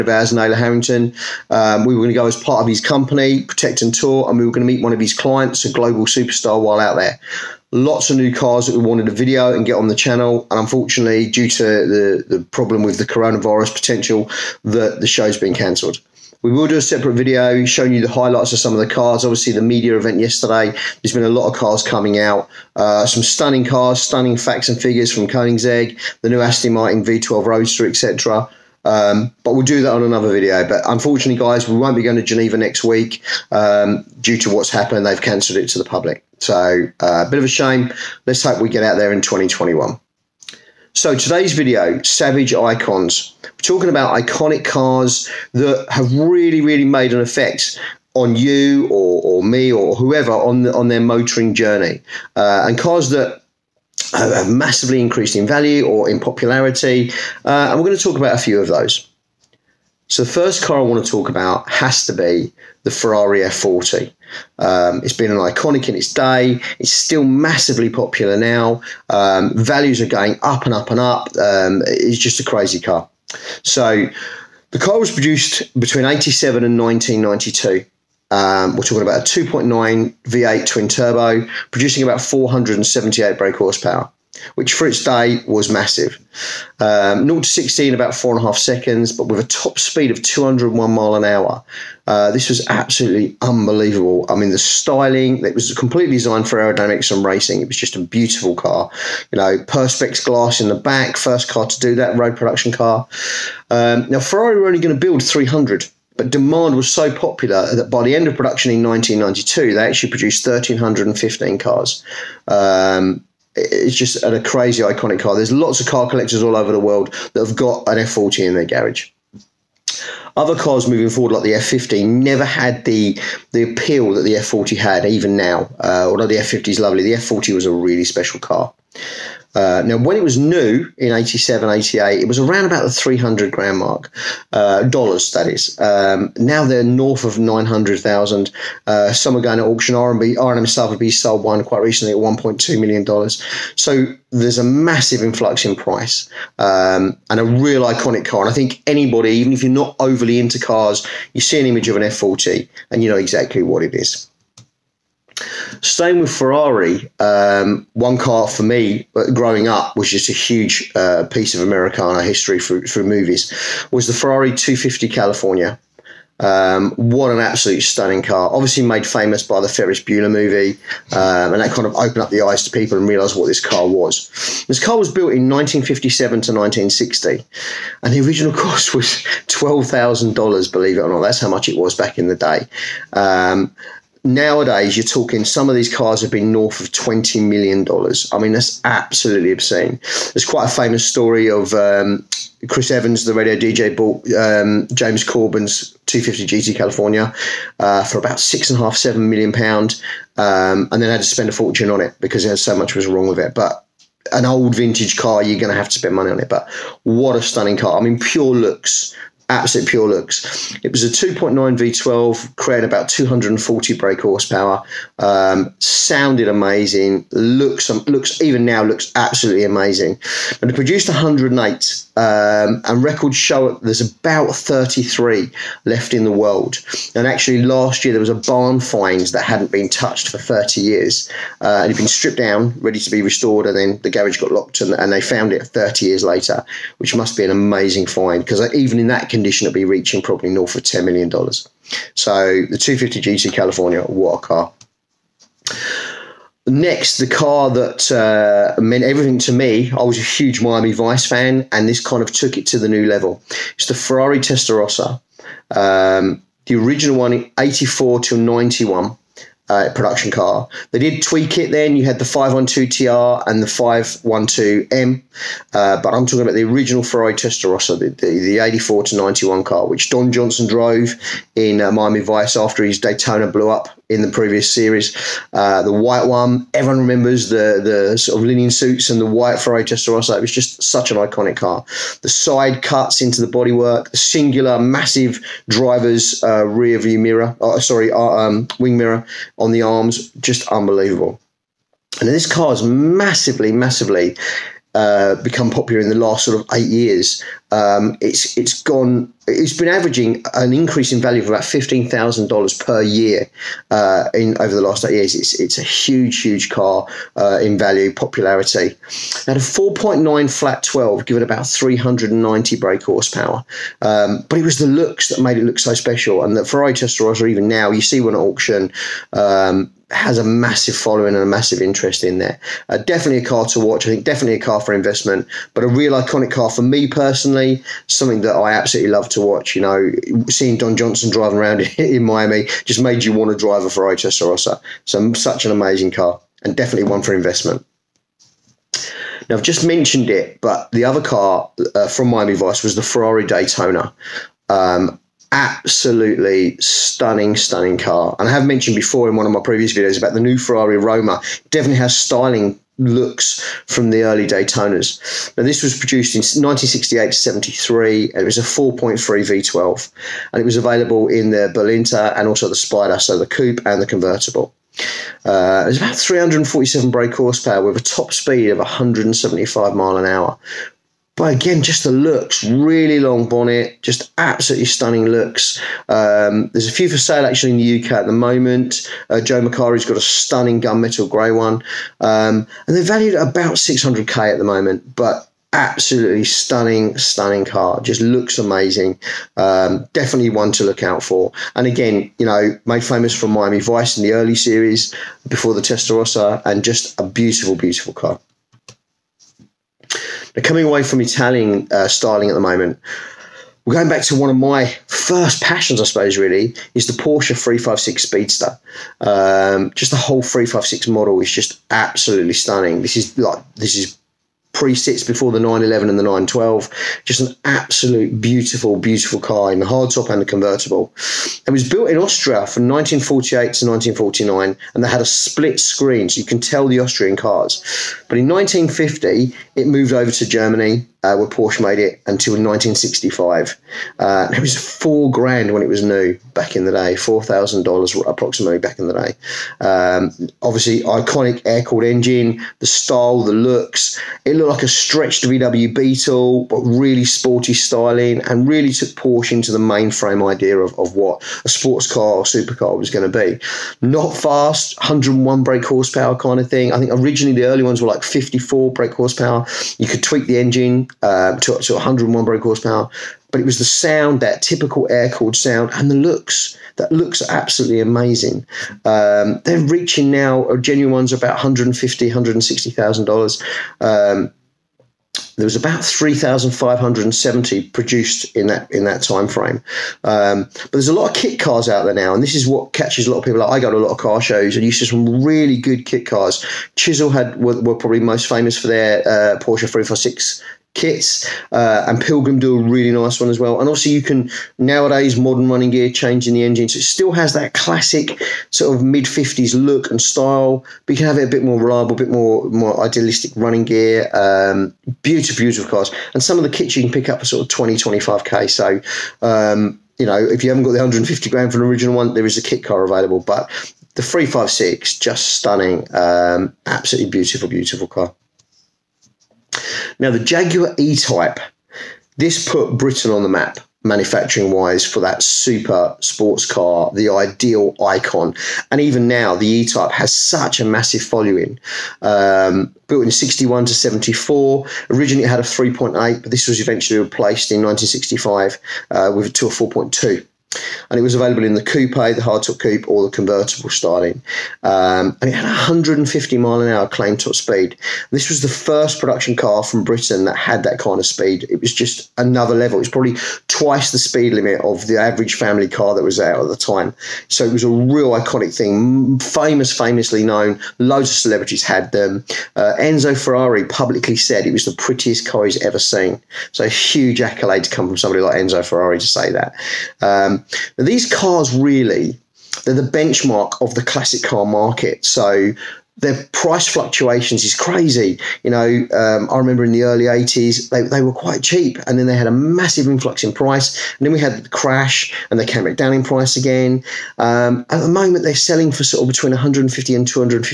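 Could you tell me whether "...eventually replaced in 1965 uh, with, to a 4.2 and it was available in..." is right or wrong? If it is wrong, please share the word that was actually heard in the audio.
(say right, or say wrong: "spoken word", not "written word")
right.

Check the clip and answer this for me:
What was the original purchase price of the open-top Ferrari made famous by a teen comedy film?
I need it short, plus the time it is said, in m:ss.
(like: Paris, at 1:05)
$12,000, at 2:59.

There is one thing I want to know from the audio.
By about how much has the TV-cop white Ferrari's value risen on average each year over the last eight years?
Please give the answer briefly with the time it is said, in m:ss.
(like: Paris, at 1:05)
$15,000, at 5:01.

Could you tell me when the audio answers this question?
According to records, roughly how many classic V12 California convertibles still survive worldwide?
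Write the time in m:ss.
3:44.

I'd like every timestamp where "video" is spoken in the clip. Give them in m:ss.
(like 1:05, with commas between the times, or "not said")
0:09, 0:17, 0:30, 0:41, 5:49.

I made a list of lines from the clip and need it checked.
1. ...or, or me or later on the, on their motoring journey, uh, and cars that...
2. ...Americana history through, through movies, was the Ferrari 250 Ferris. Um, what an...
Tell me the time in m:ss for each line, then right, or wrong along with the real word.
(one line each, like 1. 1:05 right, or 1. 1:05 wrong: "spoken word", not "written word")
1. 0:48 wrong: "whoever", not "later"
2. 2:41 wrong: "California", not "Ferris".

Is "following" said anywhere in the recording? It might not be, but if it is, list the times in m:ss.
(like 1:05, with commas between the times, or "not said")
5:20, 8:51.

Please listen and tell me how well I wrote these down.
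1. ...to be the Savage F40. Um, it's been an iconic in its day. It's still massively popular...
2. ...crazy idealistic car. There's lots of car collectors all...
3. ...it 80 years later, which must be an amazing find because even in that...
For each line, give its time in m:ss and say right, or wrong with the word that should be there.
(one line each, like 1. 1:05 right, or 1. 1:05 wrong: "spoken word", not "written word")
1. 1:02 wrong: "Ferrari", not "Savage"
2. 1:54 wrong: "iconic", not "idealistic"
3. 3:55 wrong: "30", not "80".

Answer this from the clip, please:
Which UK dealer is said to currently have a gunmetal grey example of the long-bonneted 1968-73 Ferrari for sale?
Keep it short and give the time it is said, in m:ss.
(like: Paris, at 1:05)
Joe Macari, at 6:19.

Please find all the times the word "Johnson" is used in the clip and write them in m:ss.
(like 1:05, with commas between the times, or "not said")
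4:30, 5:30.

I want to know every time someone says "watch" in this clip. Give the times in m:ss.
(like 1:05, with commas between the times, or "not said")
5:23, 5:29.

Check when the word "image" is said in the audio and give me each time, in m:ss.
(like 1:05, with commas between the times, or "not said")
2:31.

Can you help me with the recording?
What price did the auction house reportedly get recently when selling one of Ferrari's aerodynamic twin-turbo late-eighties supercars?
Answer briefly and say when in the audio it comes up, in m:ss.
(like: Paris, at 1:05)
$1.2 million, at 2:22.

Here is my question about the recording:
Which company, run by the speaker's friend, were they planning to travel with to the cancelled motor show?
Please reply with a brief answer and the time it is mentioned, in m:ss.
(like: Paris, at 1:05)
Protect and Tour, at 0:03.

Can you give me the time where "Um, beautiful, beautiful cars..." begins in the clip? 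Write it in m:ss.
8:24.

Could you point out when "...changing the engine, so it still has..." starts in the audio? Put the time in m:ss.
8:16.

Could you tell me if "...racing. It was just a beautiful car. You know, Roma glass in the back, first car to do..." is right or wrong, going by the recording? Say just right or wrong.
wrong.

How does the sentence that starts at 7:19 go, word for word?
Um, obviously, iconic air-cooled engine, the style, the looks.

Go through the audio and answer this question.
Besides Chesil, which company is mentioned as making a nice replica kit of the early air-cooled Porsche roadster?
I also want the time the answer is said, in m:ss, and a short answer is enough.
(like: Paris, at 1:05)
Pilgrim, at 8:12.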